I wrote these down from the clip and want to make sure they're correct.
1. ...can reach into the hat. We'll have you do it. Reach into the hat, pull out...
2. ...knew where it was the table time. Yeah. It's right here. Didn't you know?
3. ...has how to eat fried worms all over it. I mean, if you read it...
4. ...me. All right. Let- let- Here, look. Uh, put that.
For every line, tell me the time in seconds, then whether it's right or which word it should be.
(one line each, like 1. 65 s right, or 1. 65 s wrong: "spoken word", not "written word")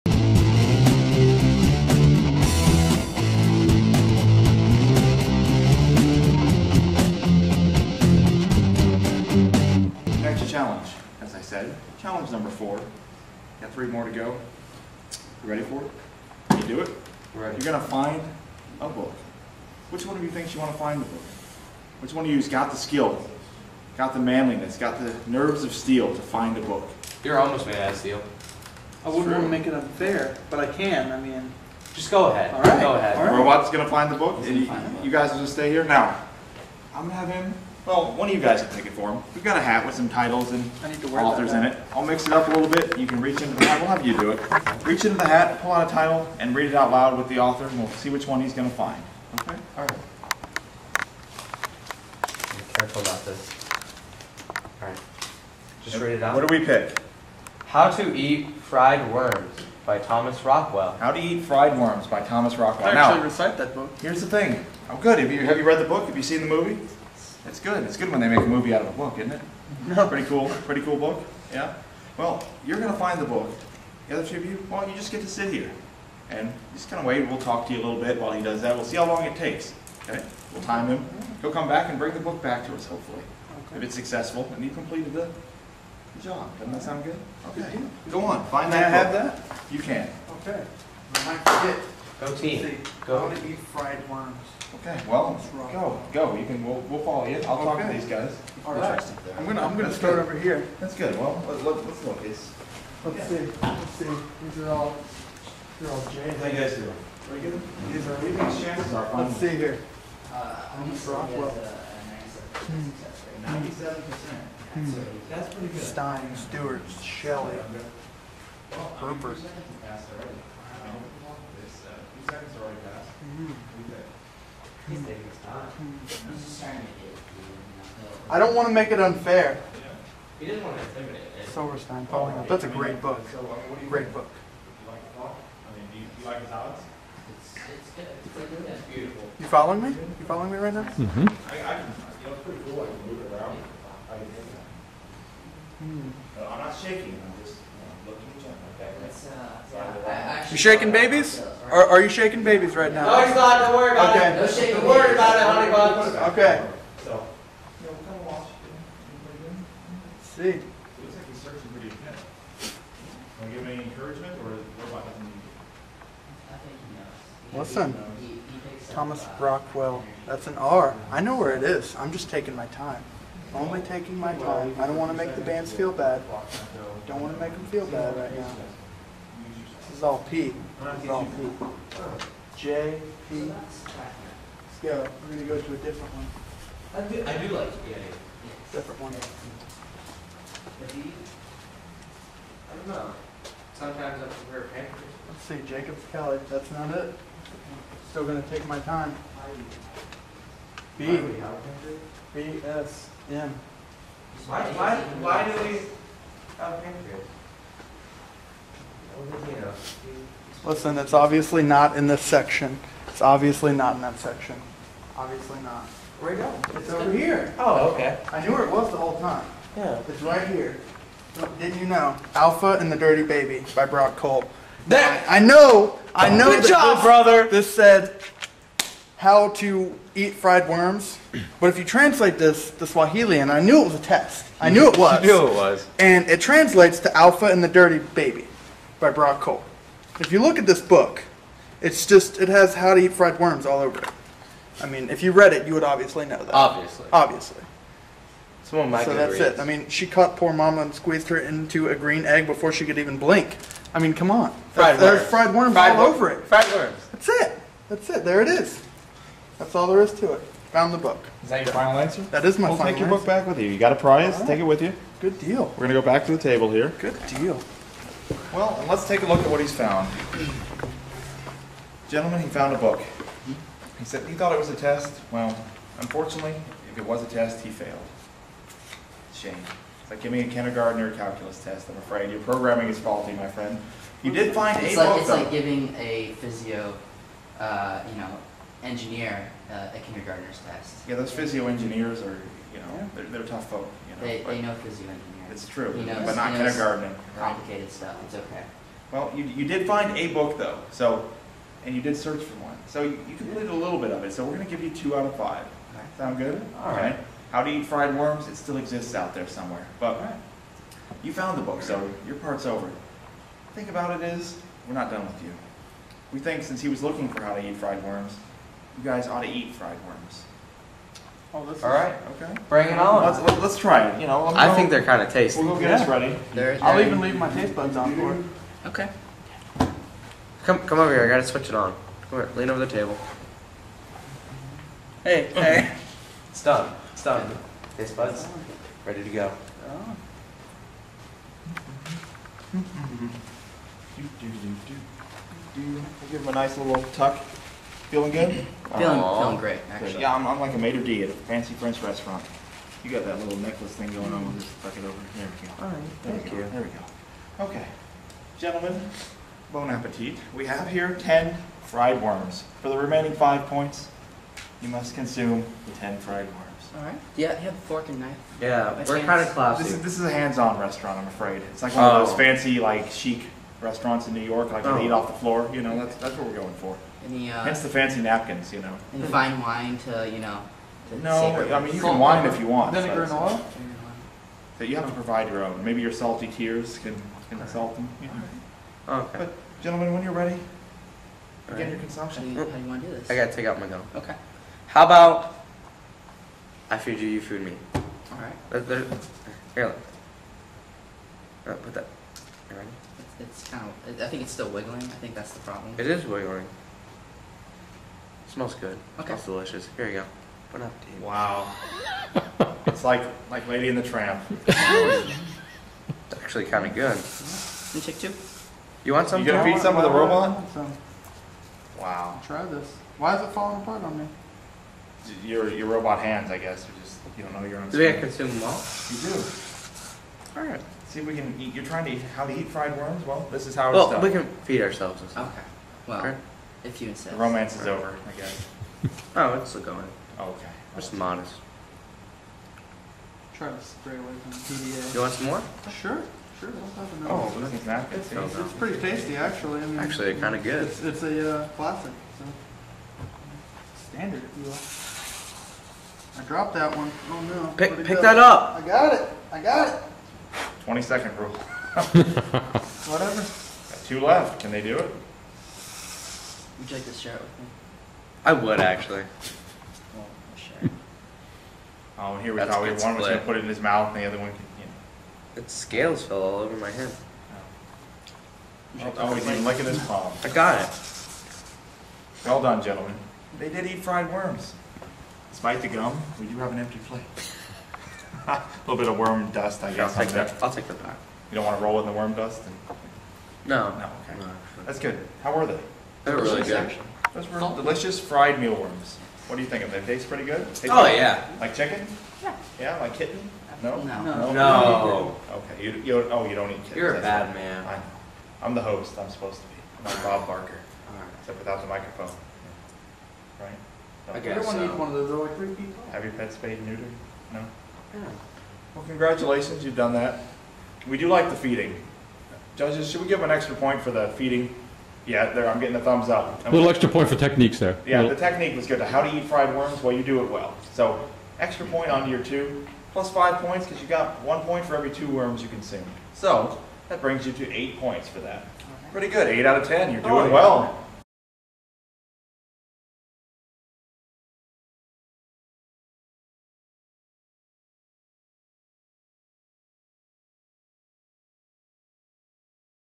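1. 43 s right
2. 218 s wrong: "whole", not "table"
3. 242 s right
4. 397 s right.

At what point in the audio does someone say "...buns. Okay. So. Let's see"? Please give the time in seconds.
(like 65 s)
155 s.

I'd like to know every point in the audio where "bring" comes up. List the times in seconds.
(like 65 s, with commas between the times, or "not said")
81 s, 322 s, 537 s.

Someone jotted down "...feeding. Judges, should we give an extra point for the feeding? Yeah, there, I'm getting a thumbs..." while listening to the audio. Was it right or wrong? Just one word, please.
right.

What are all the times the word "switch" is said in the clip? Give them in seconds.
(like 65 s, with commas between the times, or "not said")
331 s.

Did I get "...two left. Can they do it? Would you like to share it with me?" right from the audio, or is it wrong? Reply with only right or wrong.
right.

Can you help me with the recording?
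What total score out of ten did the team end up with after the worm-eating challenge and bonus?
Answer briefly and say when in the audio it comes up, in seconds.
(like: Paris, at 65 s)
8, at 539 s.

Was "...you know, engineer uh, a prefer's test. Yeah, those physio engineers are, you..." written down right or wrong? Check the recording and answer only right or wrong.
wrong.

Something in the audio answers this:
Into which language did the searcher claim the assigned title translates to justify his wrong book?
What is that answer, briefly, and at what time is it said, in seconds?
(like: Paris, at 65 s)
Swahili, at 232 s.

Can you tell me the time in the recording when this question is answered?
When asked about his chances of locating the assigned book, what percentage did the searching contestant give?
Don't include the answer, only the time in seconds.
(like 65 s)
113 s.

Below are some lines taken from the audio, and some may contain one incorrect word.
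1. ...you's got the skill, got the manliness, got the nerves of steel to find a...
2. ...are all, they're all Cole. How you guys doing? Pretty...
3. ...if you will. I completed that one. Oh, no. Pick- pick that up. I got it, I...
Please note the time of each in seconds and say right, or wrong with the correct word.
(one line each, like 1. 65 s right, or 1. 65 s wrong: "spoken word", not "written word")
1. 22 s right
2. 104 s wrong: "James", not "Cole"
3. 454 s wrong: "dropped", not "completed".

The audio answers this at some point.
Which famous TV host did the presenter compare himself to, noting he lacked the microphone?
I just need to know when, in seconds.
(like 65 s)
510 s.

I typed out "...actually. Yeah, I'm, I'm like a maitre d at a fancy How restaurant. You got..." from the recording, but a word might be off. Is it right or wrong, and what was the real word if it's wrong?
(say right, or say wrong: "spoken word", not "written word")
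wrong: "French", not "How".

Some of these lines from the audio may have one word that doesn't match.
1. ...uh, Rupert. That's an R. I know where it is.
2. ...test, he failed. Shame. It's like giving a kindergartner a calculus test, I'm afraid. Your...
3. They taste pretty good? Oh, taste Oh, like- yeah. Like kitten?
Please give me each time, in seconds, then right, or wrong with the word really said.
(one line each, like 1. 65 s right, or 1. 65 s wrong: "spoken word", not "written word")
1. 169 s wrong: "Rockwell", not "Rupert"
2. 277 s right
3. 500 s wrong: "chicken", not "kitten".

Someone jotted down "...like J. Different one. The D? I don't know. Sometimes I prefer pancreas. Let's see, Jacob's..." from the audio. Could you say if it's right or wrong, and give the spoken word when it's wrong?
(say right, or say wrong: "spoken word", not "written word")
right.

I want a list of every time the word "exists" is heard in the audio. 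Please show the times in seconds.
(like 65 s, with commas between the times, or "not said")
308 s.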